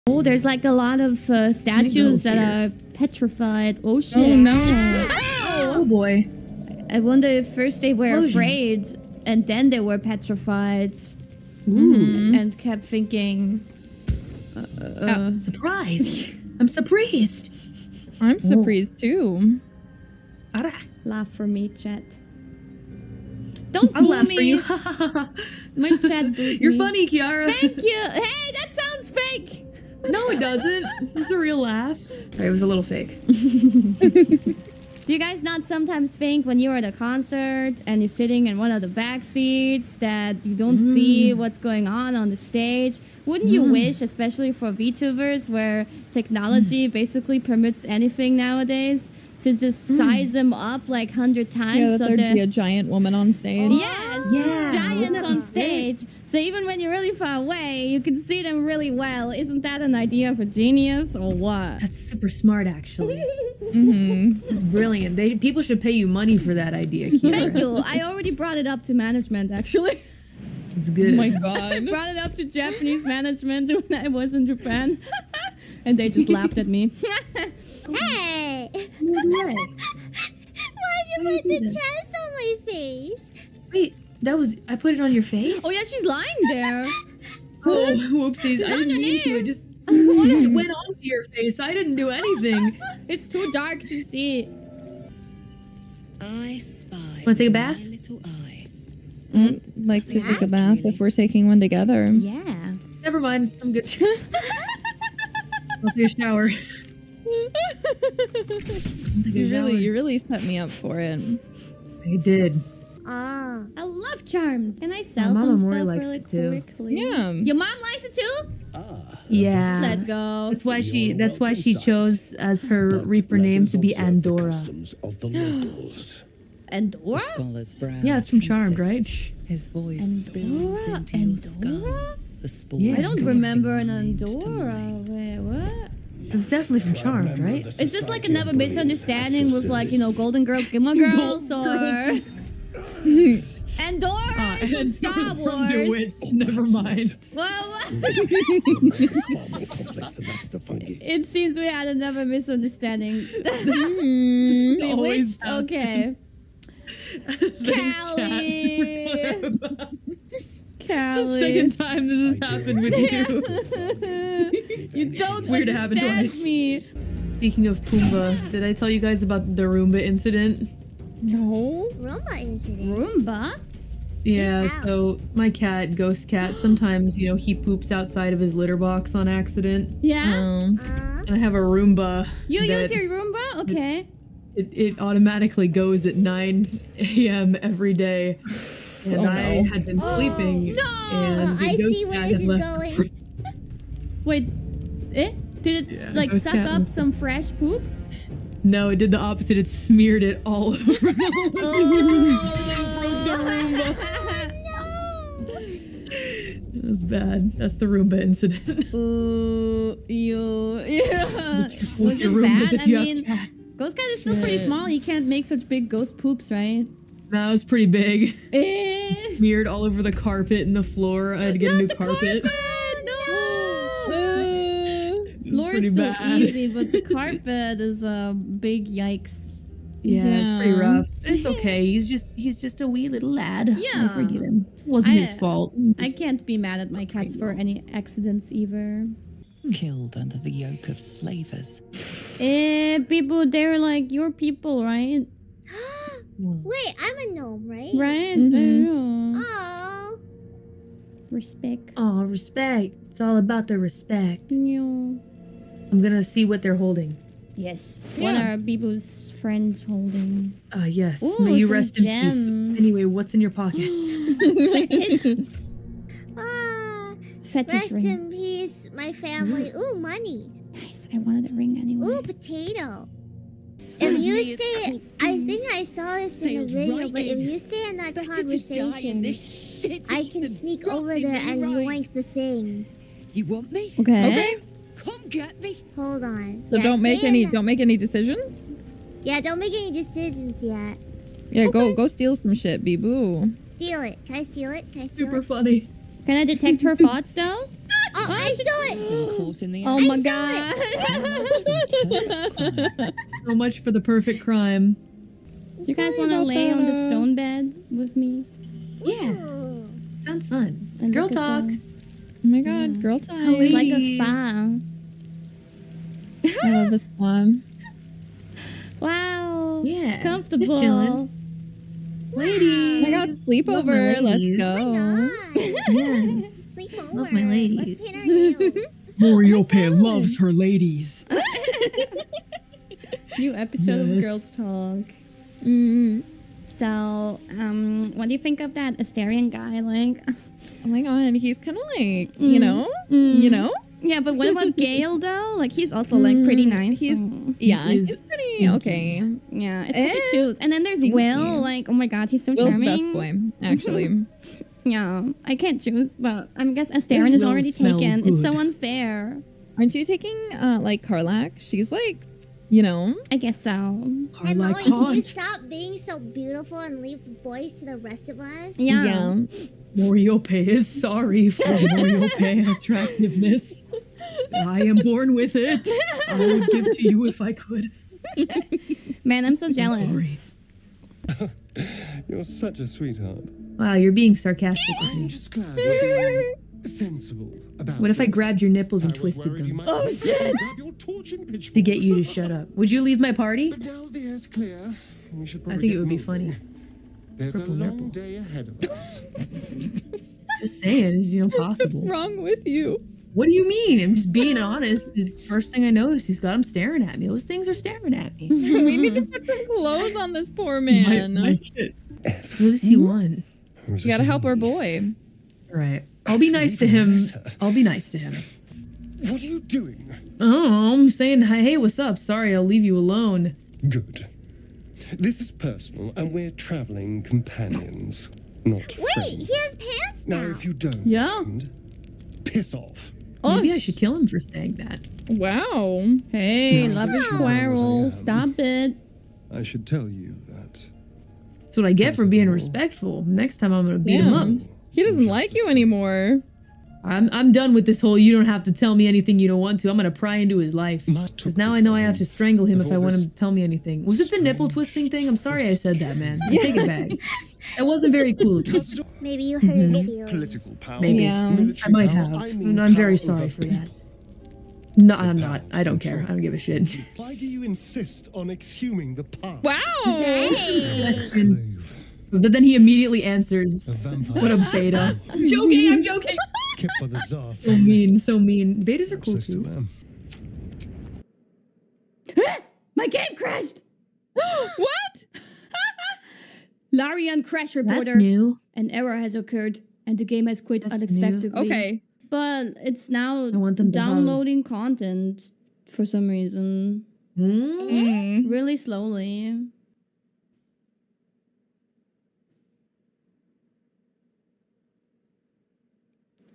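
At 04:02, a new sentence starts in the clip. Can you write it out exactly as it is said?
eh, people, they're like your people, right?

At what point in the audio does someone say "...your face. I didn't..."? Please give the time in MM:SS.
01:31.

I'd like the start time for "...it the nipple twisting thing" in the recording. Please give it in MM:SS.
07:34.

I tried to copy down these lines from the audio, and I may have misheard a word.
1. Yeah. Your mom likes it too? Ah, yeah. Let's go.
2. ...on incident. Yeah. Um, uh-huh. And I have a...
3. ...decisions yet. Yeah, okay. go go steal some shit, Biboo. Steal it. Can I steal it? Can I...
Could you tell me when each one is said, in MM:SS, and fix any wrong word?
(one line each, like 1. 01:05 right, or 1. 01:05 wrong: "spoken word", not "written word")
1. 01:56 right
2. 02:59 wrong: "accident", not "incident"
3. 04:49 right.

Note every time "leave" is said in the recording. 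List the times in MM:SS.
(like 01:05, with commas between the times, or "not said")
06:07, 06:33, 07:02.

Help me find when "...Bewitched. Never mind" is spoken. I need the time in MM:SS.
02:25.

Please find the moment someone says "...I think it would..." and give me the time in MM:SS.
06:34.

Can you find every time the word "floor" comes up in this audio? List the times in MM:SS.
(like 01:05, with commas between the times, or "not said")
03:40, 03:45.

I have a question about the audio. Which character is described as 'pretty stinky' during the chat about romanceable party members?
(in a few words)
Gale.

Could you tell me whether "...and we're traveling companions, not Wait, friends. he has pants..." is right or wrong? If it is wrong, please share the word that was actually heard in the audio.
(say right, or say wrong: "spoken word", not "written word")
right.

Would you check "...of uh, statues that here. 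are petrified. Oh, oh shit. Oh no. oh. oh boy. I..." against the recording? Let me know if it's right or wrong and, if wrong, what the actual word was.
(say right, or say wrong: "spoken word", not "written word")
right.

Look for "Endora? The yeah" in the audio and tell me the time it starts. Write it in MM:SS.
02:11.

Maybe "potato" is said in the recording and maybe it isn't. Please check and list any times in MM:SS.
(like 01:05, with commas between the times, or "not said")
04:32.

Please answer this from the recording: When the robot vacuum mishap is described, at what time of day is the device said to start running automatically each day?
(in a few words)
9 a.m.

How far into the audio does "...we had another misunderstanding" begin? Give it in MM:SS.
02:31.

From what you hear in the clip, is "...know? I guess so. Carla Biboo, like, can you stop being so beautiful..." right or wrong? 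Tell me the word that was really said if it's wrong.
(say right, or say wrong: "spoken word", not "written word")
wrong: "Emily", not "Biboo".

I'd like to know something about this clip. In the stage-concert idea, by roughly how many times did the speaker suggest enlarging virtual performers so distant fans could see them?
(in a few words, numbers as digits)
100.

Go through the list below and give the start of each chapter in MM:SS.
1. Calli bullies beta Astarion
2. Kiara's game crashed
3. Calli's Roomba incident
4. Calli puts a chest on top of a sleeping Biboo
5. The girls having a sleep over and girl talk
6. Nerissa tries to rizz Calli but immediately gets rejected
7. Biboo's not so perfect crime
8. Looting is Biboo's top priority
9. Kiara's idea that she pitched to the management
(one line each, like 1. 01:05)
1. 06:21
2. 08:00
3. 02:46
4. 01:17
5. 05:05
6. 01:35
7. 04:33
8. 03:59
9. 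00:35.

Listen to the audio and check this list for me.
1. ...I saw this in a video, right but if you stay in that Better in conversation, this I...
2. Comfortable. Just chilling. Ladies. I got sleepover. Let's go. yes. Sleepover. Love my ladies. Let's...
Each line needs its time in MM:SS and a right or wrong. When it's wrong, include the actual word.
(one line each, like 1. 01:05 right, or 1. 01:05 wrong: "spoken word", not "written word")
1. 04:35 right
2. 05:20 right.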